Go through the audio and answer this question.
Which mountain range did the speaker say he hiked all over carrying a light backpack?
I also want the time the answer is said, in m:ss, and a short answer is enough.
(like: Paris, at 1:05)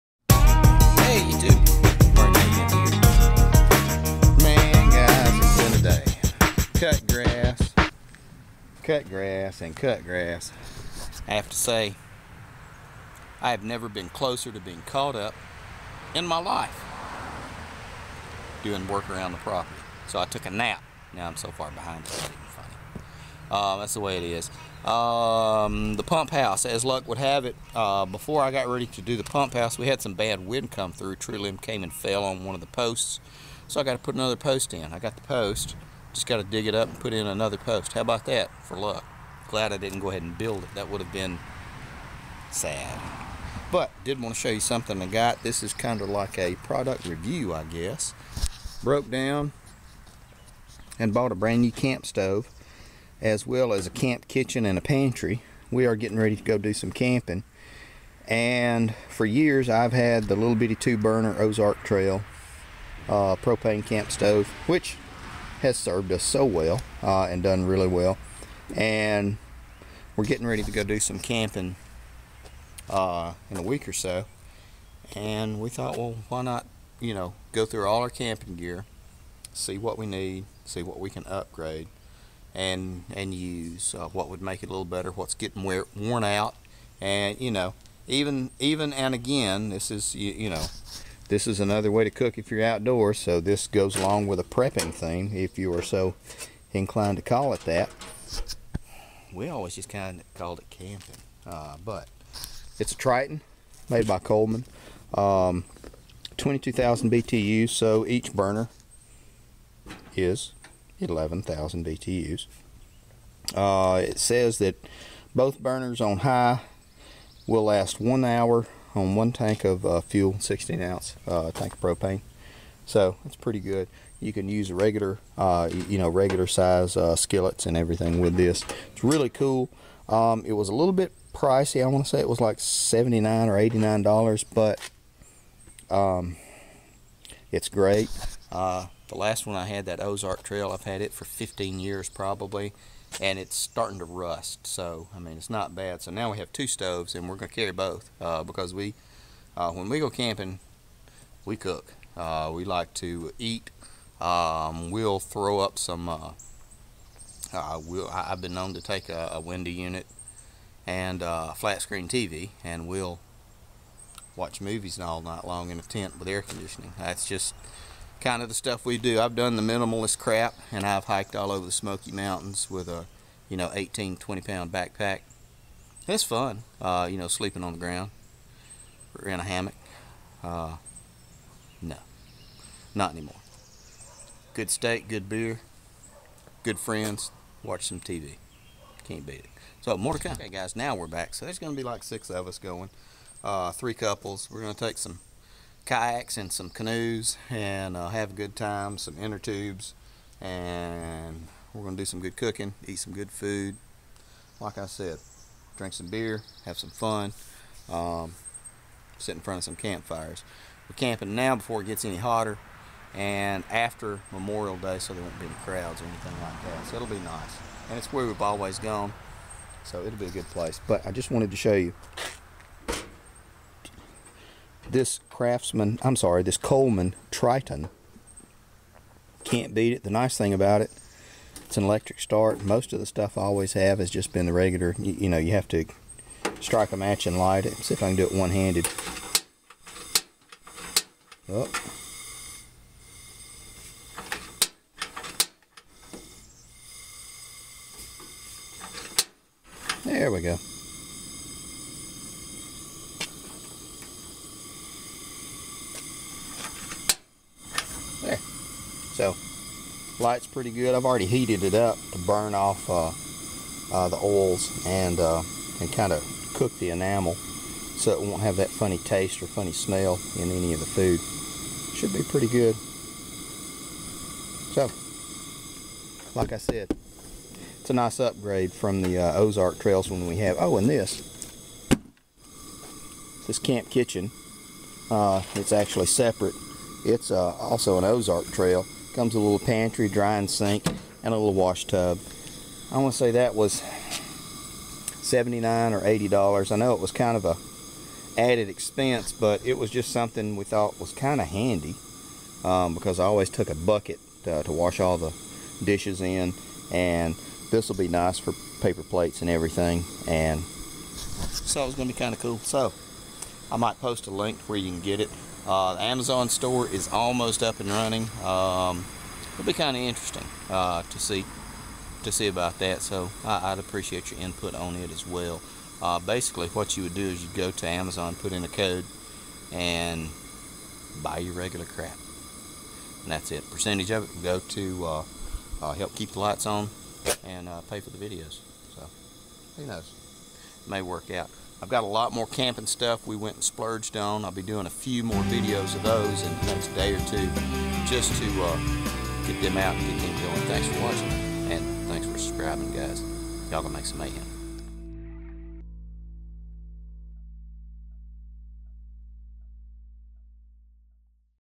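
Smoky Mountains, at 2:51.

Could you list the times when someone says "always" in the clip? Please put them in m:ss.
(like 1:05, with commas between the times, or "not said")
1:39, 3:38, 3:53, 5:03.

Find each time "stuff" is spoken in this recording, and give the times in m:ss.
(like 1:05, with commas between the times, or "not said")
2:48, 3:53, 5:42.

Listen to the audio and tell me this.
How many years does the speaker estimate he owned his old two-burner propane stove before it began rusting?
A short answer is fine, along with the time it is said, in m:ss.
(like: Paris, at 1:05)
15, at 2:21.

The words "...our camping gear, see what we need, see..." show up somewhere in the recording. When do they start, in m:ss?
1:18.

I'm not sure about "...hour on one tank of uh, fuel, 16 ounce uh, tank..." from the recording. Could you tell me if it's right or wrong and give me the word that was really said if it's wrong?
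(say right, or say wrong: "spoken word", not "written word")
right.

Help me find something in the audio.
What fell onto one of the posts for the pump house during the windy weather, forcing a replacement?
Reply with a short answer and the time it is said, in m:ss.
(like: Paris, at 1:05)
Tree limb, at 0:31.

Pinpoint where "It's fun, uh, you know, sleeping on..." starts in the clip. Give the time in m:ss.
2:56.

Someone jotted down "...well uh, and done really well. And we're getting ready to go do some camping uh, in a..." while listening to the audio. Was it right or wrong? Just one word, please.
right.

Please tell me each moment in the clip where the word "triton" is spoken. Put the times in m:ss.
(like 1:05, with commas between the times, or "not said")
1:42, 3:47.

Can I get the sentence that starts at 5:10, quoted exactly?
And so it's going to be kind of cool.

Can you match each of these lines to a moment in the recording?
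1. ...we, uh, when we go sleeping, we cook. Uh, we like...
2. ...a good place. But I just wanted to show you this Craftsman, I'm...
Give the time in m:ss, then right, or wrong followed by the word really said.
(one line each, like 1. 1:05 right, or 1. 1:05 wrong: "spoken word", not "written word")
1. 2:28 wrong: "camping", not "sleeping"
2. 3:40 right.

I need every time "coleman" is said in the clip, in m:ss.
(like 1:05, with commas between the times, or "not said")
1:44, 3:46.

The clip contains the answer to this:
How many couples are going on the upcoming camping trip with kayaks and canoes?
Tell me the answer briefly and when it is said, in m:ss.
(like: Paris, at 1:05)
3, at 3:13.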